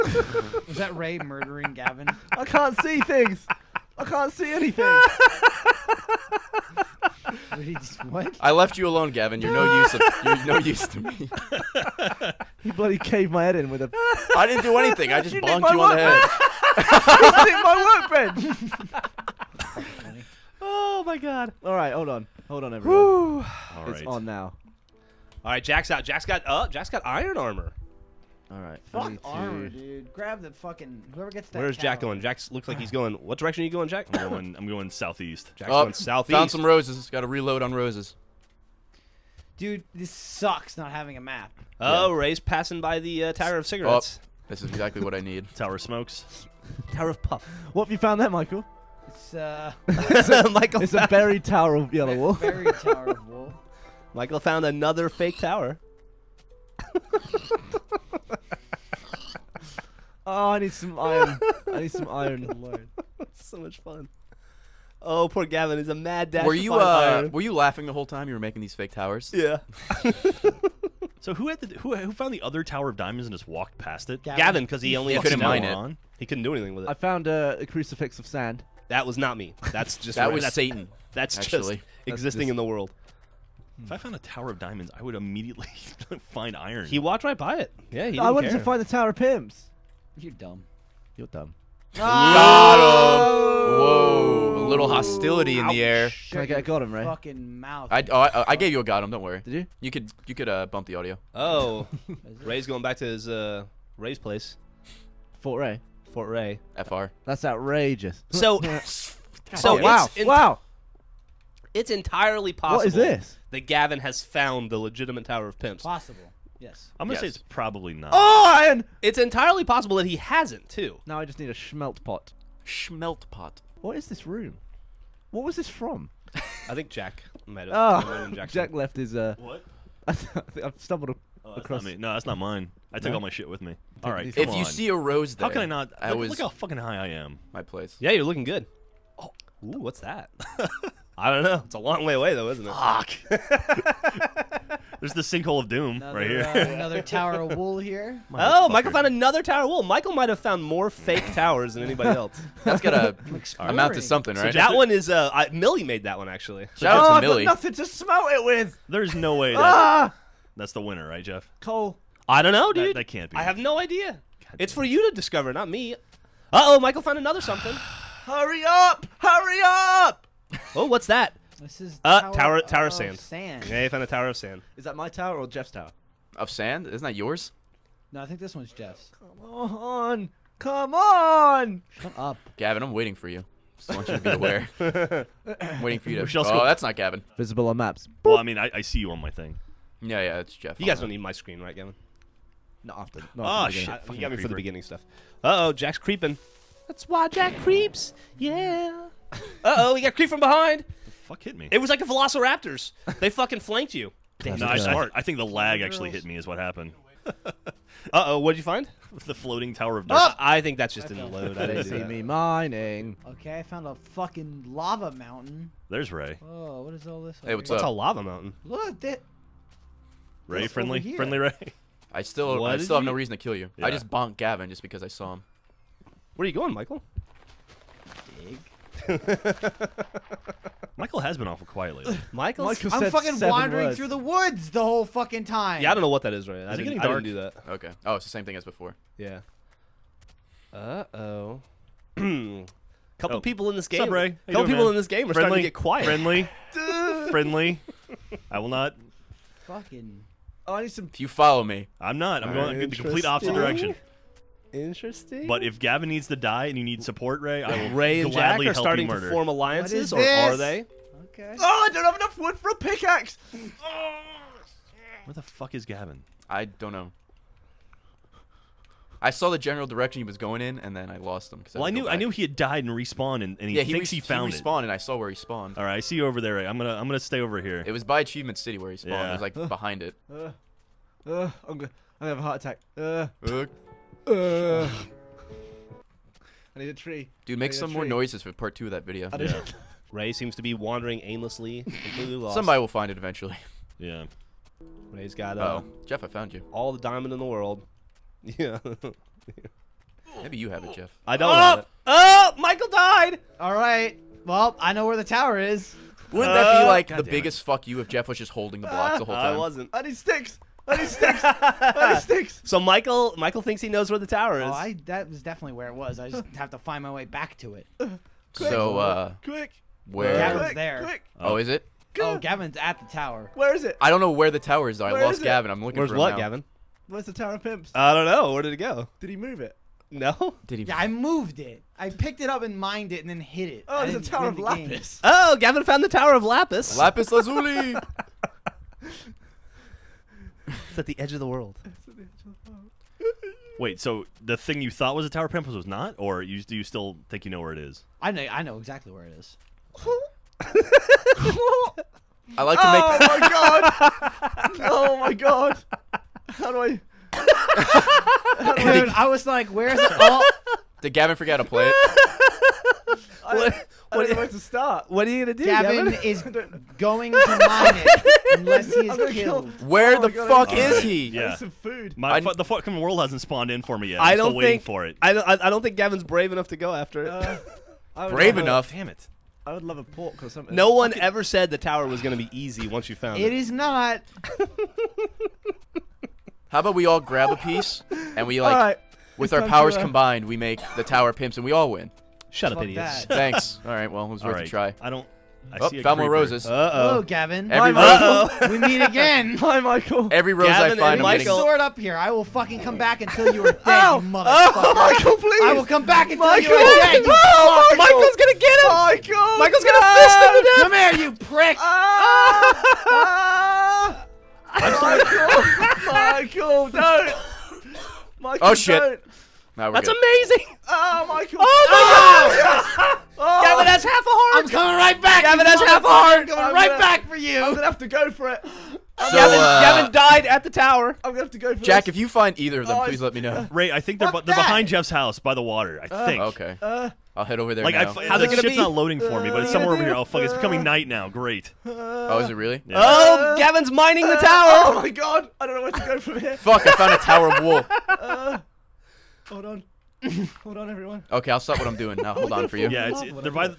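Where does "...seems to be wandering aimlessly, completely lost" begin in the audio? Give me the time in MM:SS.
04:50.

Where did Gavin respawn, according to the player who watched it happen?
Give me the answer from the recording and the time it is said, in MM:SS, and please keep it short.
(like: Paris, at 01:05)
Achievement City, at 04:38.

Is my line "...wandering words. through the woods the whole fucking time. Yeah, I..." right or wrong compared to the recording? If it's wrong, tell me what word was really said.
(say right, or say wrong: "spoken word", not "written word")
right.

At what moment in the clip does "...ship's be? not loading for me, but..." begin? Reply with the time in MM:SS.
07:18.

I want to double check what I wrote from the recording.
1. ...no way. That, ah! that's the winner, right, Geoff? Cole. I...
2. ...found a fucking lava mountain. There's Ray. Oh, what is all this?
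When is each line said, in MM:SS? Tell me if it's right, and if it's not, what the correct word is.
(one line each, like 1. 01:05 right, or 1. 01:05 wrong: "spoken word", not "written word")
1. 02:39 right
2. 03:33 right.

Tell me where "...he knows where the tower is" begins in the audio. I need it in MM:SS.
05:13.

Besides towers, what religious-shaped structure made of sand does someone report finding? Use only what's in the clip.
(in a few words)
A crucifix of sand.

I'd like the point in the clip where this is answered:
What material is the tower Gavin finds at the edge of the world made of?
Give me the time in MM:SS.
05:36.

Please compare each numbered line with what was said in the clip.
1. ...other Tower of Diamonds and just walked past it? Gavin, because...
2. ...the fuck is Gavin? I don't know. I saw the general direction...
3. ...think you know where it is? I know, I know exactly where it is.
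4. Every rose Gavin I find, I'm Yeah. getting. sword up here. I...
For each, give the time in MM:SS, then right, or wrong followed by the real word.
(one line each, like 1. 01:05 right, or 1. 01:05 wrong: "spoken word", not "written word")
1. 01:12 right
2. 04:25 right
3. 05:47 right
4. 06:40 wrong: "Michael", not "Yeah".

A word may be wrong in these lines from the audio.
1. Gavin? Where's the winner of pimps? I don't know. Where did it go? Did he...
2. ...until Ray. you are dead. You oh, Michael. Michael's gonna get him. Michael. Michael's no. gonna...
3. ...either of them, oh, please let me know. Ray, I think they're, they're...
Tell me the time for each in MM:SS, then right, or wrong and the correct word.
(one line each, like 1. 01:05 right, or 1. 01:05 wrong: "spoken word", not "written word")
1. 05:26 wrong: "tower", not "winner"
2. 06:46 wrong: "Michael", not "Ray"
3. 07:12 right.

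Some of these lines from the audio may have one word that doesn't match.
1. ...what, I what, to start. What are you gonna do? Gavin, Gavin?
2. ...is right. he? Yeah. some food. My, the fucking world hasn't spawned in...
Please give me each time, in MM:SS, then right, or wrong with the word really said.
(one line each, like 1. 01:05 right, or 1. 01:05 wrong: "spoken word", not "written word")
1. 06:03 right
2. 06:10 right.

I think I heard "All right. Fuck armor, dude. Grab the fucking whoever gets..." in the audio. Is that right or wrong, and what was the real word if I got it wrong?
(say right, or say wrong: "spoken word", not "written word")
right.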